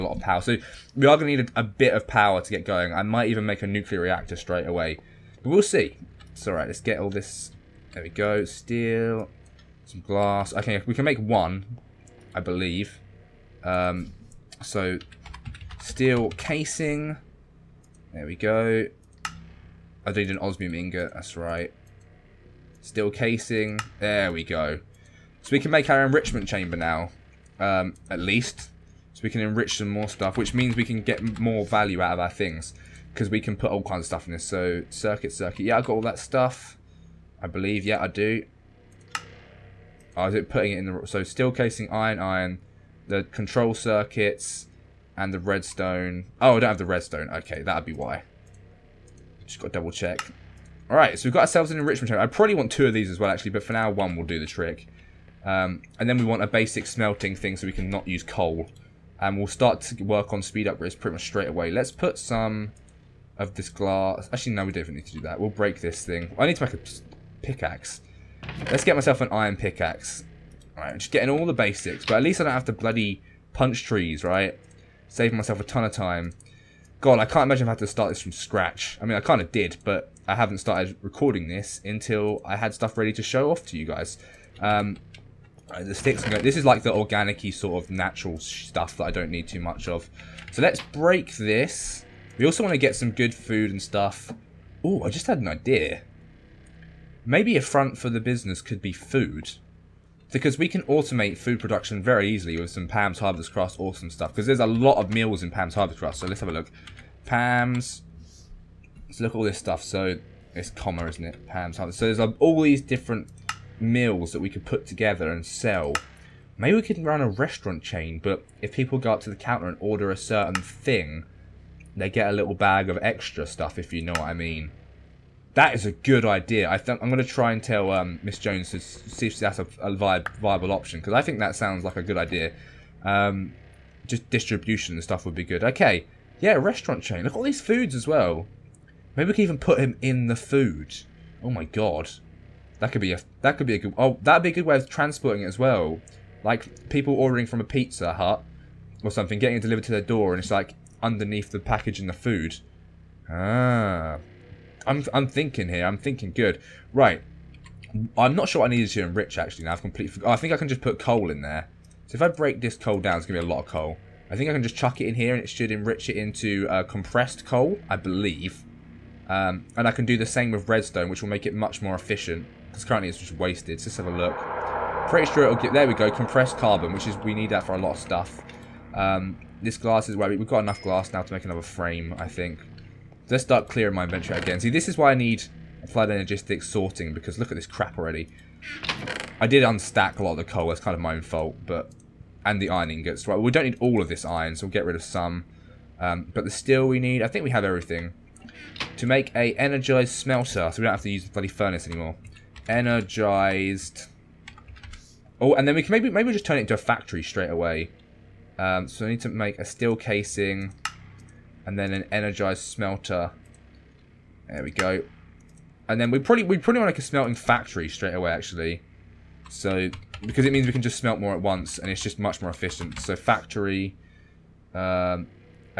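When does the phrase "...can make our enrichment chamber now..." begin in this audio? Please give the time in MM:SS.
00:25.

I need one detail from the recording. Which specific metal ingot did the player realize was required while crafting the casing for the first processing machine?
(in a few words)
Osmium ingot.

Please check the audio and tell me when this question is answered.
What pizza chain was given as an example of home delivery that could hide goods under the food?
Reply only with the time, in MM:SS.
02:27.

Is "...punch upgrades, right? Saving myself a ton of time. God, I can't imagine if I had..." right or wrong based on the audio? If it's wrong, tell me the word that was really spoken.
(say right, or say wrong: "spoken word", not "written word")
wrong: "trees", not "upgrades".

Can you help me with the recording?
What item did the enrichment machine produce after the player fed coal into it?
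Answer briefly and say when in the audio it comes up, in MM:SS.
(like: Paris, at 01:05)
Compressed carbon, at 02:56.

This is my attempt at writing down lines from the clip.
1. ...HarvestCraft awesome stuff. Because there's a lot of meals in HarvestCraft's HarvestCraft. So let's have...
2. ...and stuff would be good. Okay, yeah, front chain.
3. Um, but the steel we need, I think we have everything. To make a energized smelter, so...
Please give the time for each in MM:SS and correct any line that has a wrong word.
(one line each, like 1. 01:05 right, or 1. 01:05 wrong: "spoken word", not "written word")
1. 01:43 wrong: "Pam", not "HarvestCraft"
2. 02:14 wrong: "restaurant", not "front"
3. 03:15 right.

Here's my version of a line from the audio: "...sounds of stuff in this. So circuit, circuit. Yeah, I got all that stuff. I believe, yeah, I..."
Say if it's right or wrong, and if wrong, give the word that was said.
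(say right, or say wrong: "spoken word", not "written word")
wrong: "kinds", not "sounds".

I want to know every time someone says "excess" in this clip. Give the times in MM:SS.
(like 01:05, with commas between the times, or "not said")
not said.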